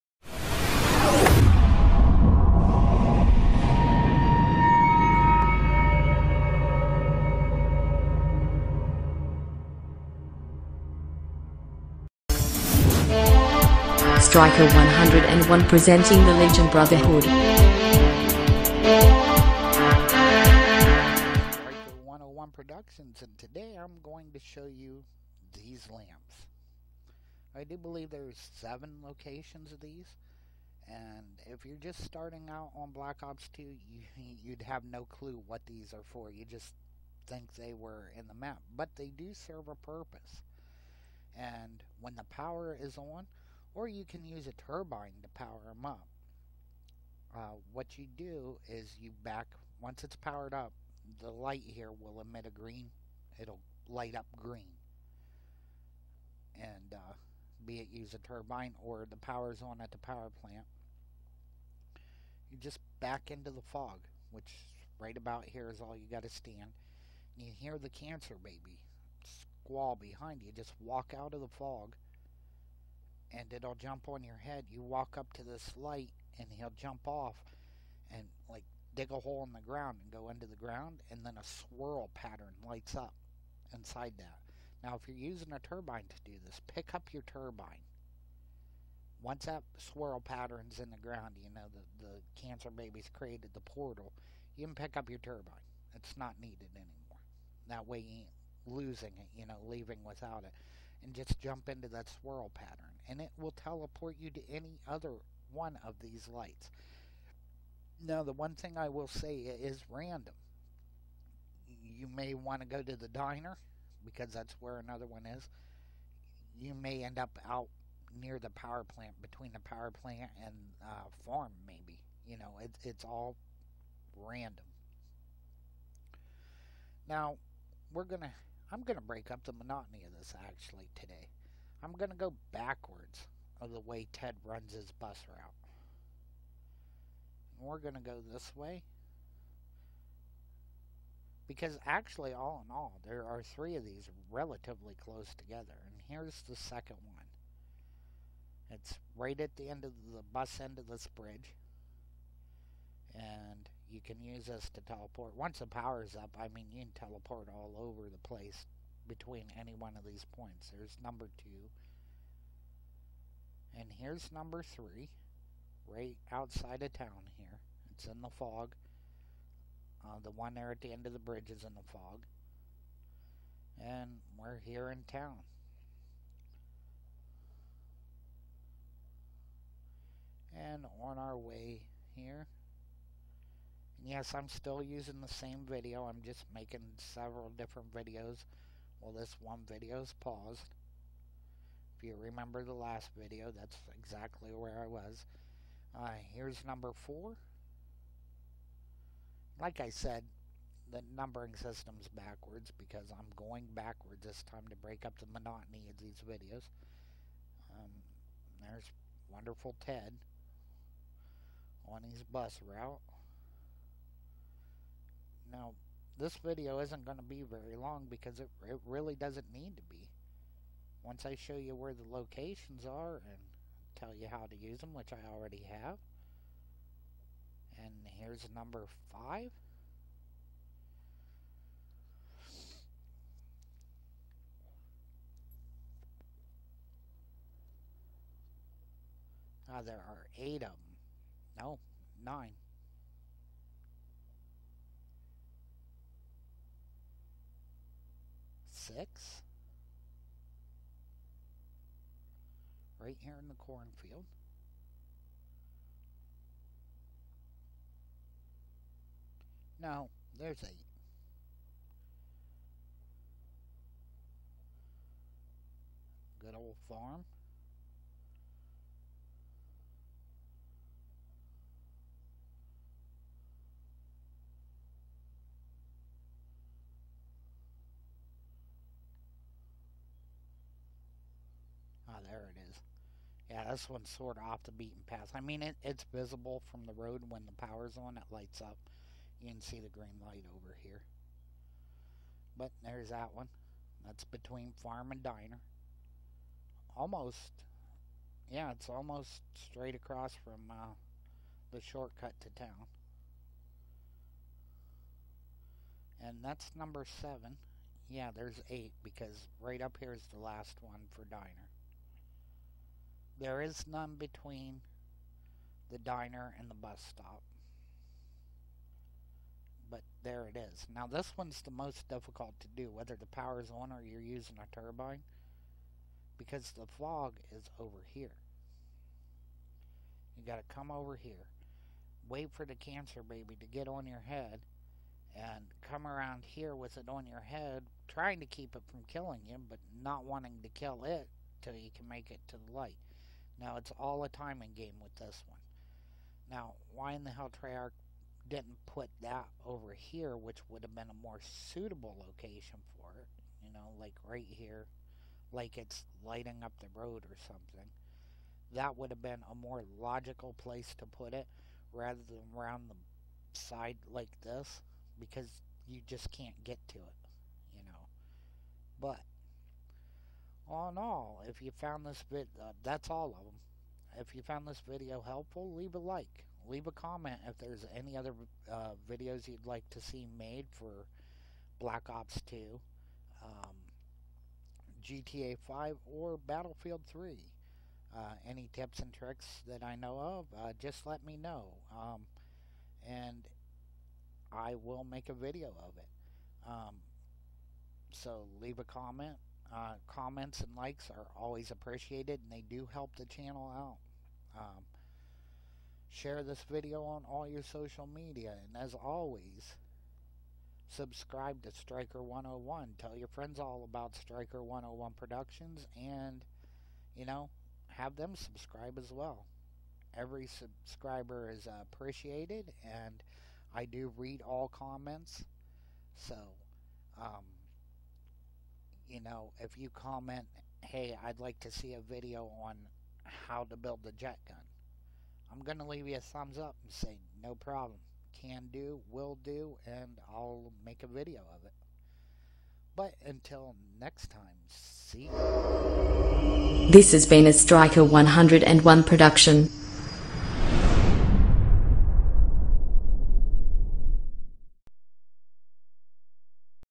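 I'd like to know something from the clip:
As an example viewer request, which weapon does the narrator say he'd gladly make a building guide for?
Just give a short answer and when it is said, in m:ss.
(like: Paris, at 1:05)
The jet gun, at 7:14.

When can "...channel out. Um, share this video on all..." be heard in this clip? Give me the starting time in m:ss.
6:43.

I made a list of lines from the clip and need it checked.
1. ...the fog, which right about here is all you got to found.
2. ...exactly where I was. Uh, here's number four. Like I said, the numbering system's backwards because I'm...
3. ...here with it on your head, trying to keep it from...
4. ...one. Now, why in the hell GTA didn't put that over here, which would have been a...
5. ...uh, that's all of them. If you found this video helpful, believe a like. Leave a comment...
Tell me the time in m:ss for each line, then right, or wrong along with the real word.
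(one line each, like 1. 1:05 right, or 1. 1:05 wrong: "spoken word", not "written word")
1. 1:03 wrong: "stand", not "found"
2. 3:13 right
3. 5:36 right
4. 5:45 wrong: "Treyarch", not "GTA"
5. 6:12 wrong: "leave", not "believe".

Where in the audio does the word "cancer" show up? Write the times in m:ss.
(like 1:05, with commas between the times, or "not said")
1:07, 1:32, 5:32.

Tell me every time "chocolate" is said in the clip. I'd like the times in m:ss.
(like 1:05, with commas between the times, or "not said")
not said.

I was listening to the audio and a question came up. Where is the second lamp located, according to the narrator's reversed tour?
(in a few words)
End of the bridge.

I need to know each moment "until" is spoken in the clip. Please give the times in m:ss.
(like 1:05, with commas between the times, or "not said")
7:23.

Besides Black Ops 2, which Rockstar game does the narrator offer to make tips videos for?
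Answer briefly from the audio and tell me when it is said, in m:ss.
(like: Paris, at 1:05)
GTA 5, at 6:25.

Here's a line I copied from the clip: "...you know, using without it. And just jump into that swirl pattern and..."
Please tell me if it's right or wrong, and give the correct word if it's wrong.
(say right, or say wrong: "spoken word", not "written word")
wrong: "leaving", not "using".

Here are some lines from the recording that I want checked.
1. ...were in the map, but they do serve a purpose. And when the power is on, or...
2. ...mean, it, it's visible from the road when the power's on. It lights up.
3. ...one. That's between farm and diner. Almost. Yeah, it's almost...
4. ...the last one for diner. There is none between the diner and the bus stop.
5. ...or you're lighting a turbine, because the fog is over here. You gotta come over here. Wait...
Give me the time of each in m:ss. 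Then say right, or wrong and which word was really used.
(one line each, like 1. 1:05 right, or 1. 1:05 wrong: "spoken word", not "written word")
1. 0:37 right
2. 4:45 right
3. 4:53 right
4. 5:10 right
5. 5:23 wrong: "using", not "lighting".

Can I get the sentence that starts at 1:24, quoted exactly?
Now if you're using a turbine to do this, pick up your turbine.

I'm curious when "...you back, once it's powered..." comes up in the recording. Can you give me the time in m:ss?
0:48.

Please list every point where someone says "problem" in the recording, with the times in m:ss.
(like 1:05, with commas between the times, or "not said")
7:17.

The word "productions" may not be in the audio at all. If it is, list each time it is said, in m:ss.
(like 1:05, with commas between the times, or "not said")
0:22, 6:55, 7:29.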